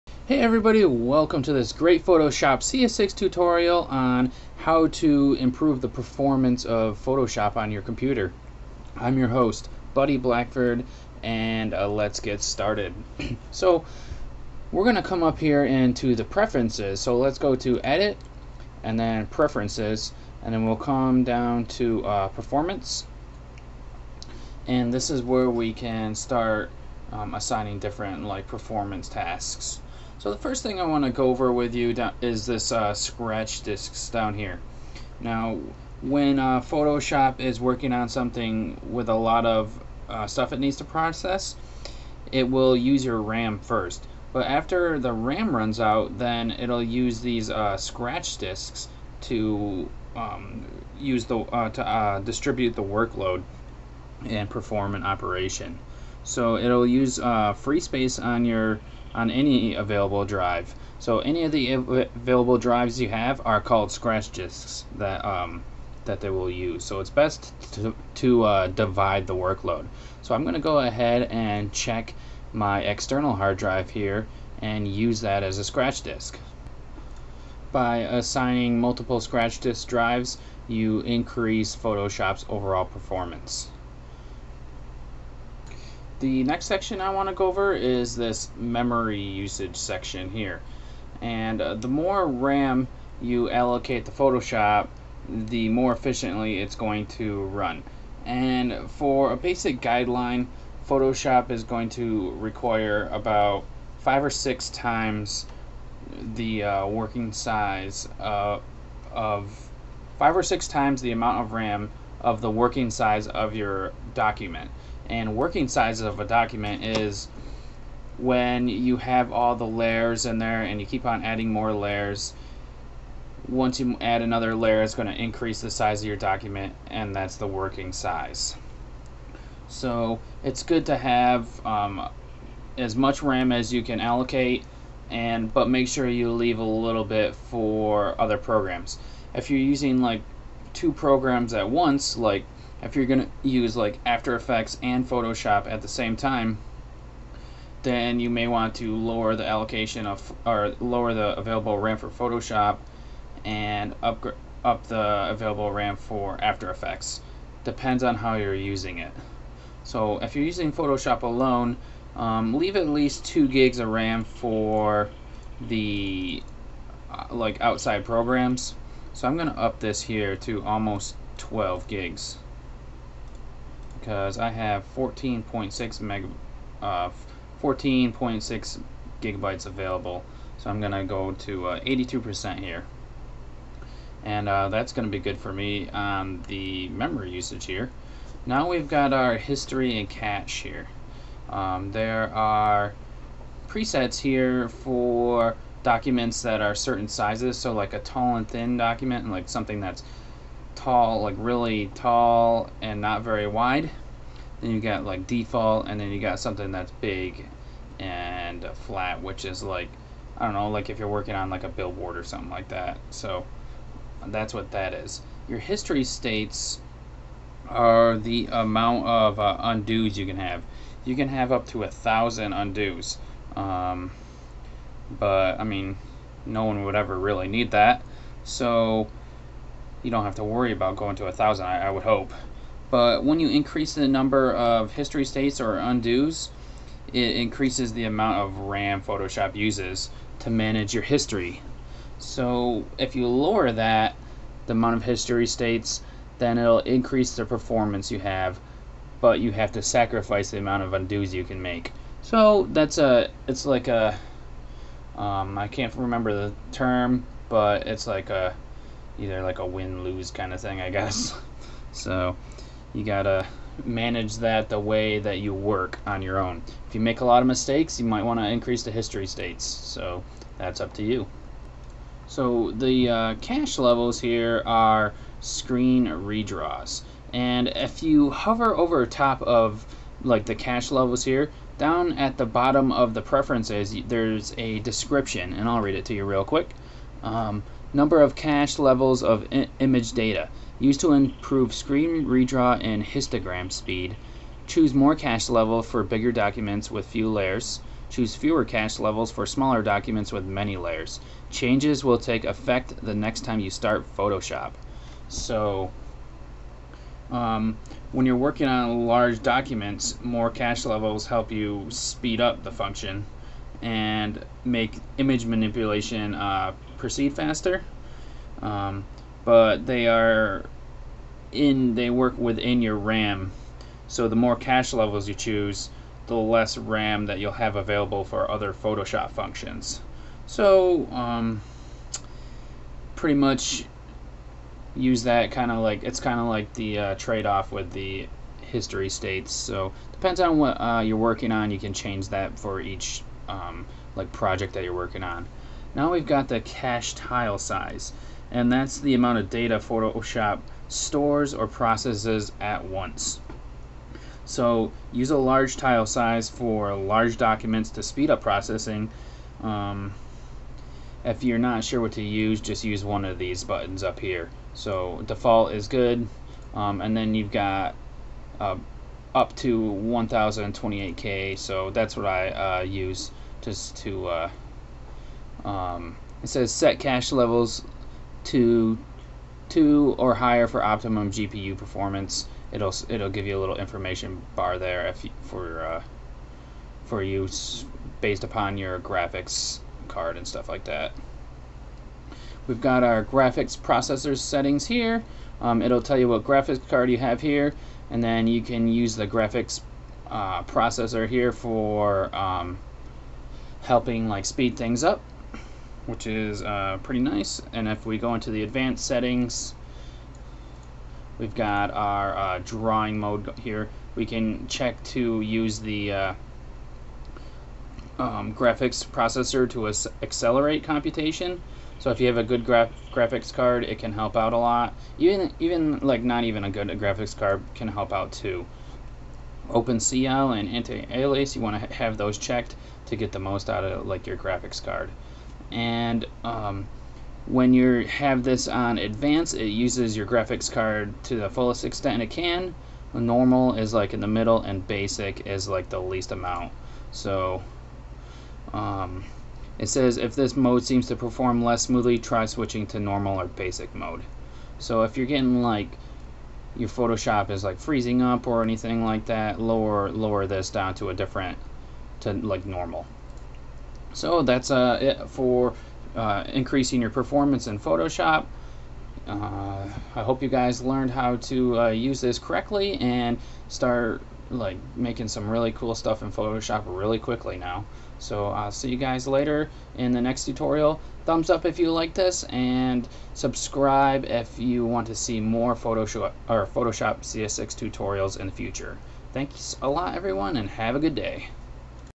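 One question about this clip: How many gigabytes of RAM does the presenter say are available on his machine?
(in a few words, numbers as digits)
14.6 gigabytes.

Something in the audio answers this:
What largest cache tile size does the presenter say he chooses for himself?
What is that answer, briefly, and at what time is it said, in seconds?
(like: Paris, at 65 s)
1028K, at 369 s.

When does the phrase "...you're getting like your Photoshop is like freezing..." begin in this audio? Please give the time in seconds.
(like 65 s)
455 s.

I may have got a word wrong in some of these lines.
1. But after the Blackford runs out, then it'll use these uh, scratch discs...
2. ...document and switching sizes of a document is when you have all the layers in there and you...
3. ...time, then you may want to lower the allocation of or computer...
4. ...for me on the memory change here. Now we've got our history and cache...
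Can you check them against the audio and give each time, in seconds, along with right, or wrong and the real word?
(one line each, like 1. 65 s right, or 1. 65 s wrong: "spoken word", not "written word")
1. 44 s wrong: "RAM", not "Blackford"
2. 114 s wrong: "working", not "switching"
3. 146 s wrong: "lower", not "computer"
4. 185 s wrong: "usage", not "change".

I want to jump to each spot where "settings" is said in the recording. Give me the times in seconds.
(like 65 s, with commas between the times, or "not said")
394 s, 409 s.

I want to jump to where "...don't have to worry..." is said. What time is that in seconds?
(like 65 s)
230 s.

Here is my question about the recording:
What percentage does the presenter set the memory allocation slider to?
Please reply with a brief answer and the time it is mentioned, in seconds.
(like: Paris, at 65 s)
82%, at 181 s.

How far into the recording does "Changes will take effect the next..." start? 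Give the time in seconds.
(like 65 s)
301 s.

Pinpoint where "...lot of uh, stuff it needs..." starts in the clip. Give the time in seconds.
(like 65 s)
39 s.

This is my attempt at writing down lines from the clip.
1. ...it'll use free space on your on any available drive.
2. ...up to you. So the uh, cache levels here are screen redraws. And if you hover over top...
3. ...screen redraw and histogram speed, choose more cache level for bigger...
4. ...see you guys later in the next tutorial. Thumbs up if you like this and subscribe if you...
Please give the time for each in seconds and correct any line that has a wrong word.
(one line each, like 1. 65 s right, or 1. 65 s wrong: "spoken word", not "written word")
1. 56 s right
2. 270 s right
3. 291 s right
4. 478 s right.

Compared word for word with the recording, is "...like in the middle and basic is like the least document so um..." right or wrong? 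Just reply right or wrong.
wrong.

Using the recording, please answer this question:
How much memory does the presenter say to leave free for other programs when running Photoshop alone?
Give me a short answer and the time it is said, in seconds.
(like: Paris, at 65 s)
2 gigs, at 163 s.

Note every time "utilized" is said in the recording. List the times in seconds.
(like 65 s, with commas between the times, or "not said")
not said.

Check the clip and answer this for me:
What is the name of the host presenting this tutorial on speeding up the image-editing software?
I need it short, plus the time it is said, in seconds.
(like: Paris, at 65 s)
Buddy Blackford, at 9 s.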